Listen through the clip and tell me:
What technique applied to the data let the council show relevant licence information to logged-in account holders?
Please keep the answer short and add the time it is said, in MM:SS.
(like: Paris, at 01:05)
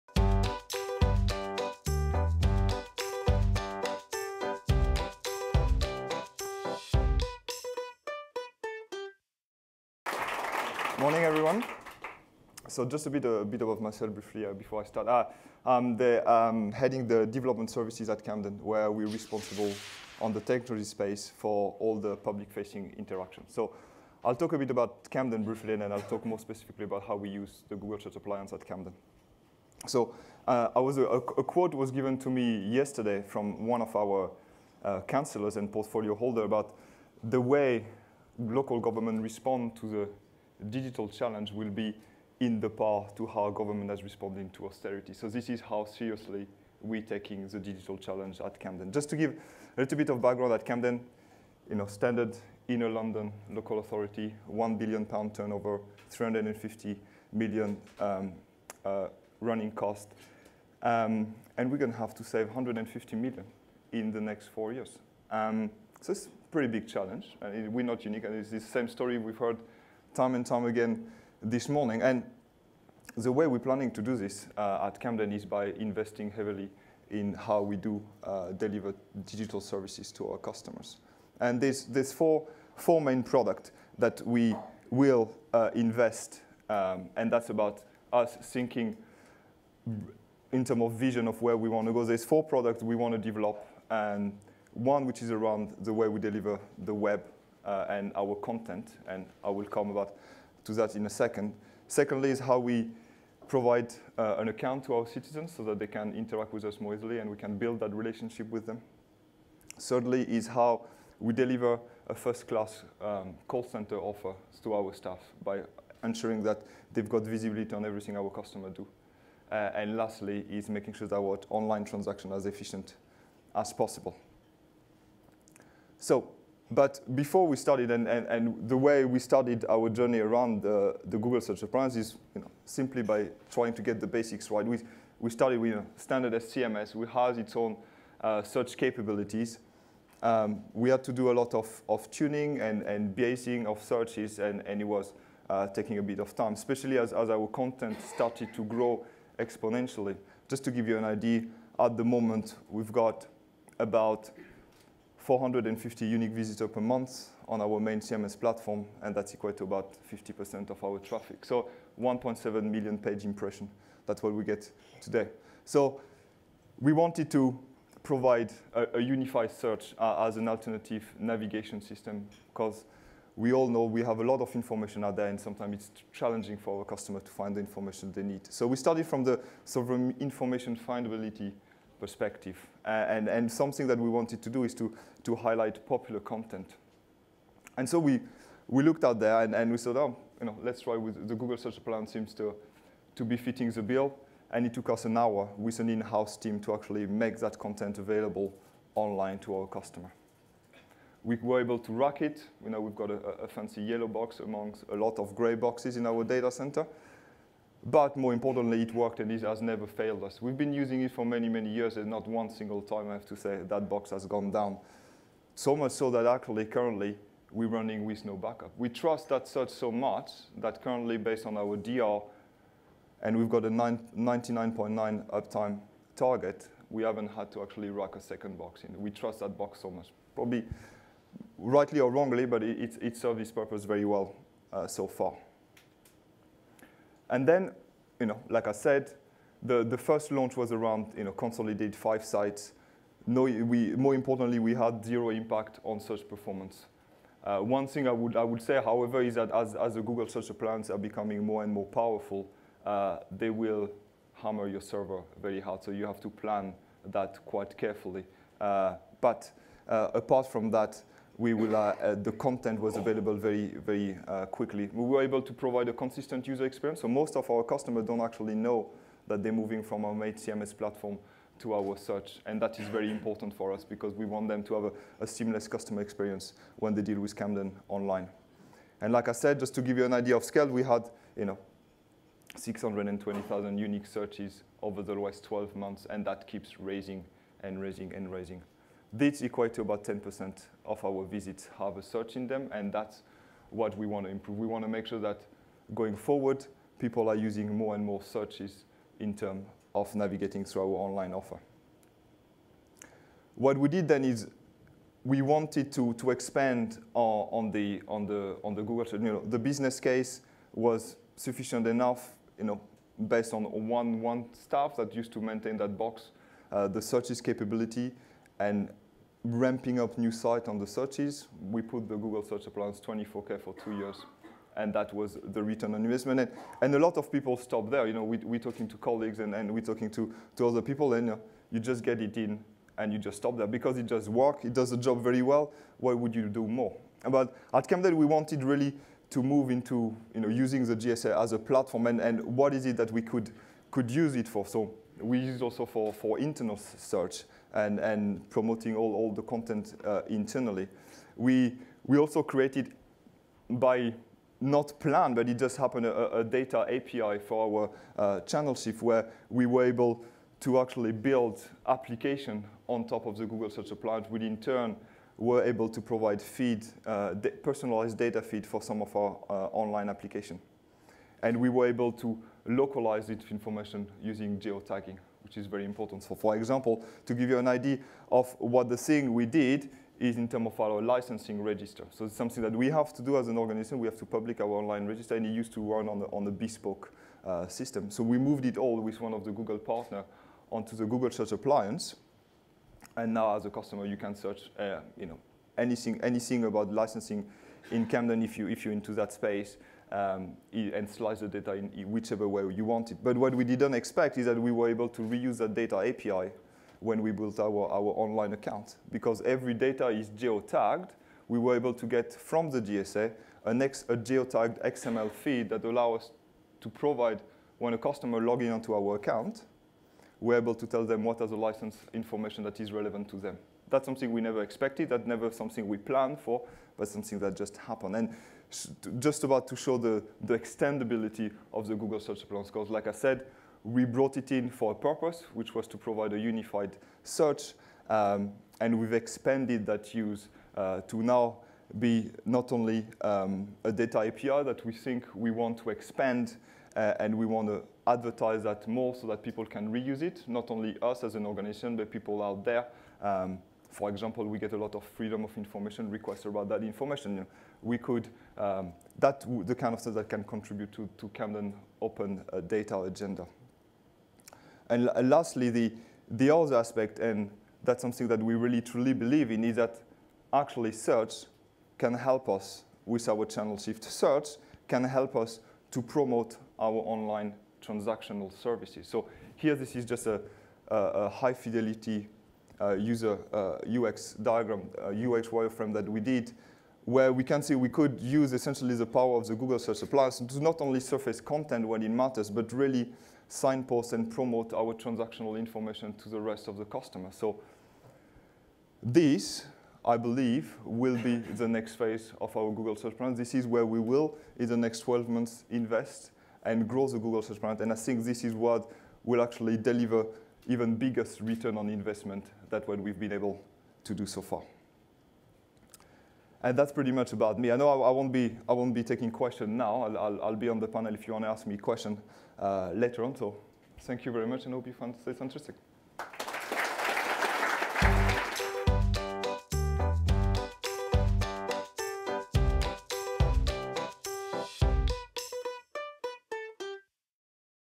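Geotagging, at 06:14.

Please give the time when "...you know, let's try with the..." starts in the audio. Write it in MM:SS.
03:10.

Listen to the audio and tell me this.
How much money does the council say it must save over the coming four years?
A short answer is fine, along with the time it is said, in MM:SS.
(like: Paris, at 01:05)
150 million, at 01:02.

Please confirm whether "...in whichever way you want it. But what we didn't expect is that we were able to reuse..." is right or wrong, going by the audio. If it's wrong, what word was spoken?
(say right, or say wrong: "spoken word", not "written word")
right.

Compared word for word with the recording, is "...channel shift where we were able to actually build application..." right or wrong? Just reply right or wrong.
right.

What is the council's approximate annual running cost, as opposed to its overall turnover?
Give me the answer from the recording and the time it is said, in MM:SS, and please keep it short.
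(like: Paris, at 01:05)
350 million, at 00:56.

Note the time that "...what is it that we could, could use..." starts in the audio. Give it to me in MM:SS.
05:42.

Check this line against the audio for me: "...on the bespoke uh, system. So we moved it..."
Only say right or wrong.
right.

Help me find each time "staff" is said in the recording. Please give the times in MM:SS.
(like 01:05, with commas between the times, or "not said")
01:54, 05:14.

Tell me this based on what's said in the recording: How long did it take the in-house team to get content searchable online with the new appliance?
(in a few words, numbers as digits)
An hour.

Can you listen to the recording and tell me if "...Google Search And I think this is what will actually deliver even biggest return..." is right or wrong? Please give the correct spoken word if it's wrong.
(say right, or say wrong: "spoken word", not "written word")
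right.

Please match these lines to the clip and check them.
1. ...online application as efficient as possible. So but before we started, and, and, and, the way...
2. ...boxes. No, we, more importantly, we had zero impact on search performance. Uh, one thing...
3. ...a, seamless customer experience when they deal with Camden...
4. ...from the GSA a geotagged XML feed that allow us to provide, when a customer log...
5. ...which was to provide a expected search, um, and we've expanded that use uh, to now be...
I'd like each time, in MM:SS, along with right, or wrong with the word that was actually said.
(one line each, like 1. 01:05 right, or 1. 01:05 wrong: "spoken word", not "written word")
1. 02:01 wrong: "transaction", not "application"
2. 04:02 wrong: "sites", not "boxes"
3. 04:35 right
4. 06:52 right
5. 07:15 wrong: "unified", not "expected".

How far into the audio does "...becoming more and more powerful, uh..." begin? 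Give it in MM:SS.
04:10.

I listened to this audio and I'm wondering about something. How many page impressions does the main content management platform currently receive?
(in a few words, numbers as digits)
1.7 million.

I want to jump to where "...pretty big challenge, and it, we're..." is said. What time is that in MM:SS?
01:06.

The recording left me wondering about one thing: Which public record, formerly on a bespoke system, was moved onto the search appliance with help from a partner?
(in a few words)
Licensing register.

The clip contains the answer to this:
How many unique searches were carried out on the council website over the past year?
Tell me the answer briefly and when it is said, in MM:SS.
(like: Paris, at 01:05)
620,000, at 04:42.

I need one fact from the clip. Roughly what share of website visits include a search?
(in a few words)
10%.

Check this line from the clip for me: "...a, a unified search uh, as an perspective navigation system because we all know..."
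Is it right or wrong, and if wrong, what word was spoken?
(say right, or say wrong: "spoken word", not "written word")
wrong: "alternative", not "perspective".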